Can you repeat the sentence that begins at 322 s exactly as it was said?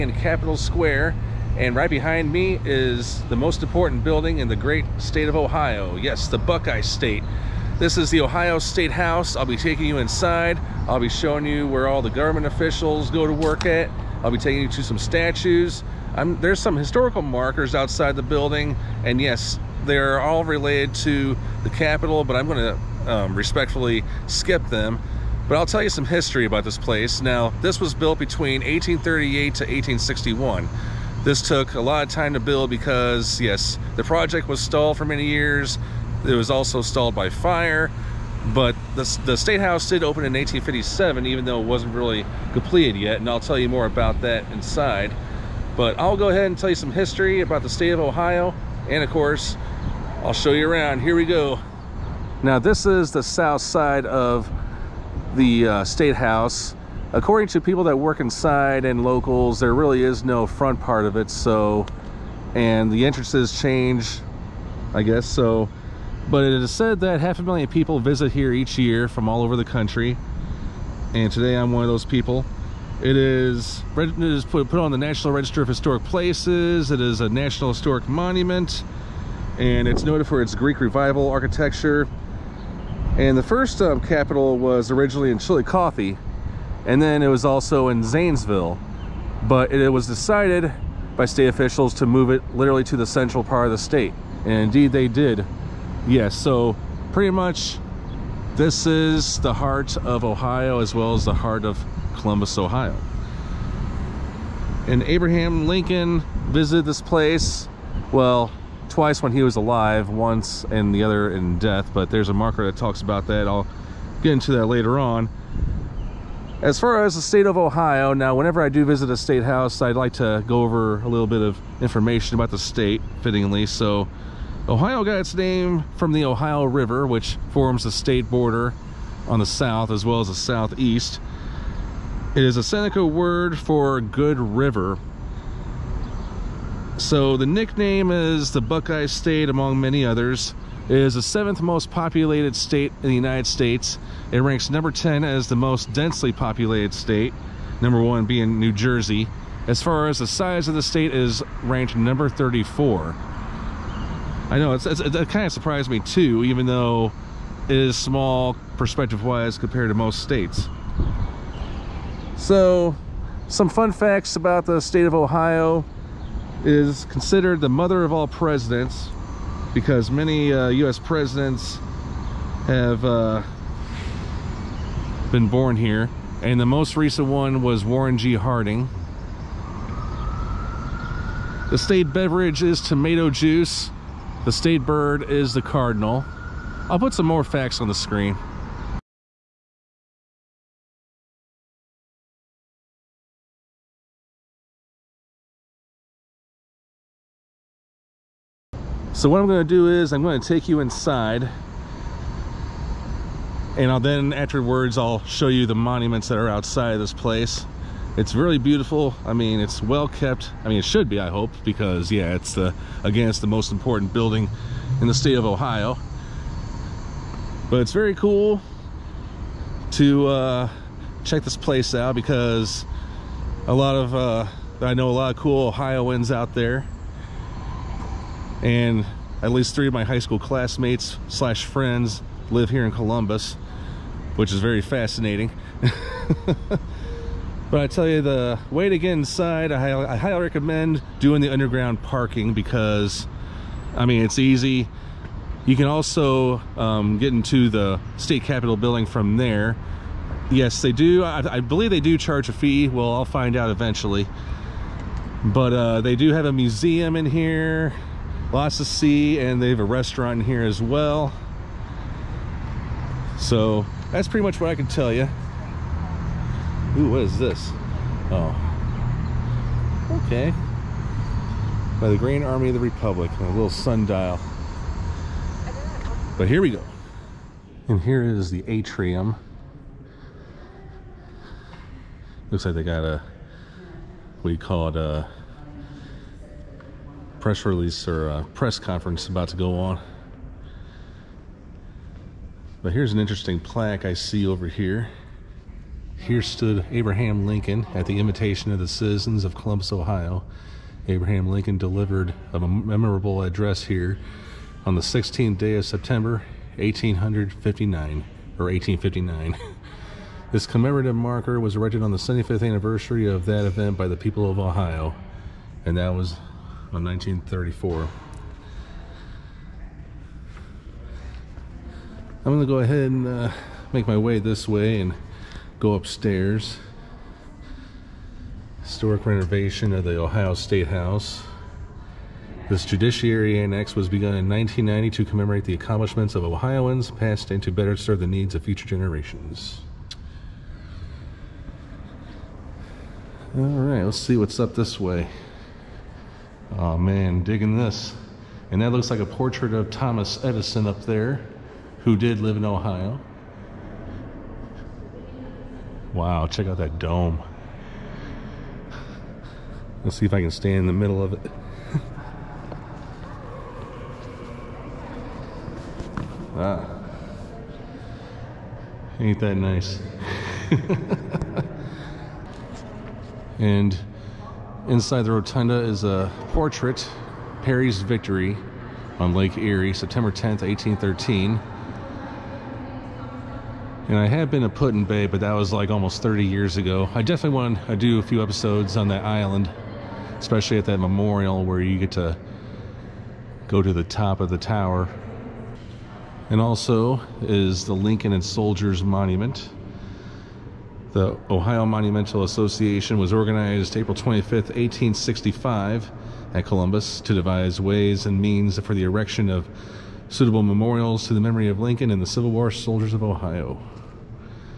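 I'm gonna go ahead and uh, make my way this way and go upstairs.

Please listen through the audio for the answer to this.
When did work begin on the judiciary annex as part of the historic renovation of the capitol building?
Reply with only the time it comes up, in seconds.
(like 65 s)
334 s.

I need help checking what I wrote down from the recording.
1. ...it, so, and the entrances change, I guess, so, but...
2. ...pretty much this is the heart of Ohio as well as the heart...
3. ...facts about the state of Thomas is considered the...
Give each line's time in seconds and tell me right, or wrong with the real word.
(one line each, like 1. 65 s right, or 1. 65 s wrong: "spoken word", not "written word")
1. 61 s right
2. 97 s right
3. 163 s wrong: "Ohio", not "Thomas".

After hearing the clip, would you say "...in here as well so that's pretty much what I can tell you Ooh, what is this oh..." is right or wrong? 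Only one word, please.
right.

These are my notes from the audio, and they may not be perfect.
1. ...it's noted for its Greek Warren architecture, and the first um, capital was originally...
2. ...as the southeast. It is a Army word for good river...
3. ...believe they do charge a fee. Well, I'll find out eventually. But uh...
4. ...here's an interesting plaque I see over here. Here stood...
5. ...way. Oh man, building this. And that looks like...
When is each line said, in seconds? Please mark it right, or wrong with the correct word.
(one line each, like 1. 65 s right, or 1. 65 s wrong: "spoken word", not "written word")
1. 79 s wrong: "Revival", not "Warren"
2. 130 s wrong: "Seneca", not "Army"
3. 251 s right
4. 292 s right
5. 344 s wrong: "digging", not "building".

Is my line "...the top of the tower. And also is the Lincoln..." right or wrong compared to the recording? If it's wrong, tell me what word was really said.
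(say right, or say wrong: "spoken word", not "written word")
right.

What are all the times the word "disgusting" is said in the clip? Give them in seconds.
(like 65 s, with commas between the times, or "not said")
not said.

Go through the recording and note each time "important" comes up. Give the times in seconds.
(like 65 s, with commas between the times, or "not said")
3 s, 213 s.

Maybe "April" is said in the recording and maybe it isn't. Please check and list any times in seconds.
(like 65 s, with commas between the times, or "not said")
403 s.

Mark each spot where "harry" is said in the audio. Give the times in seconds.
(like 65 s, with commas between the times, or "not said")
not said.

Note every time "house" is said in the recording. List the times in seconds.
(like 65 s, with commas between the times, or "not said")
8 s, 39 s, 56 s, 119 s, 330 s.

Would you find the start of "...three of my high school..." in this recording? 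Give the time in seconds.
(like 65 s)
229 s.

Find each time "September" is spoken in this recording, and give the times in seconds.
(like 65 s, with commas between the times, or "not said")
305 s, 379 s.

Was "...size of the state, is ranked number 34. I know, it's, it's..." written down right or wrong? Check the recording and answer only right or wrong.
right.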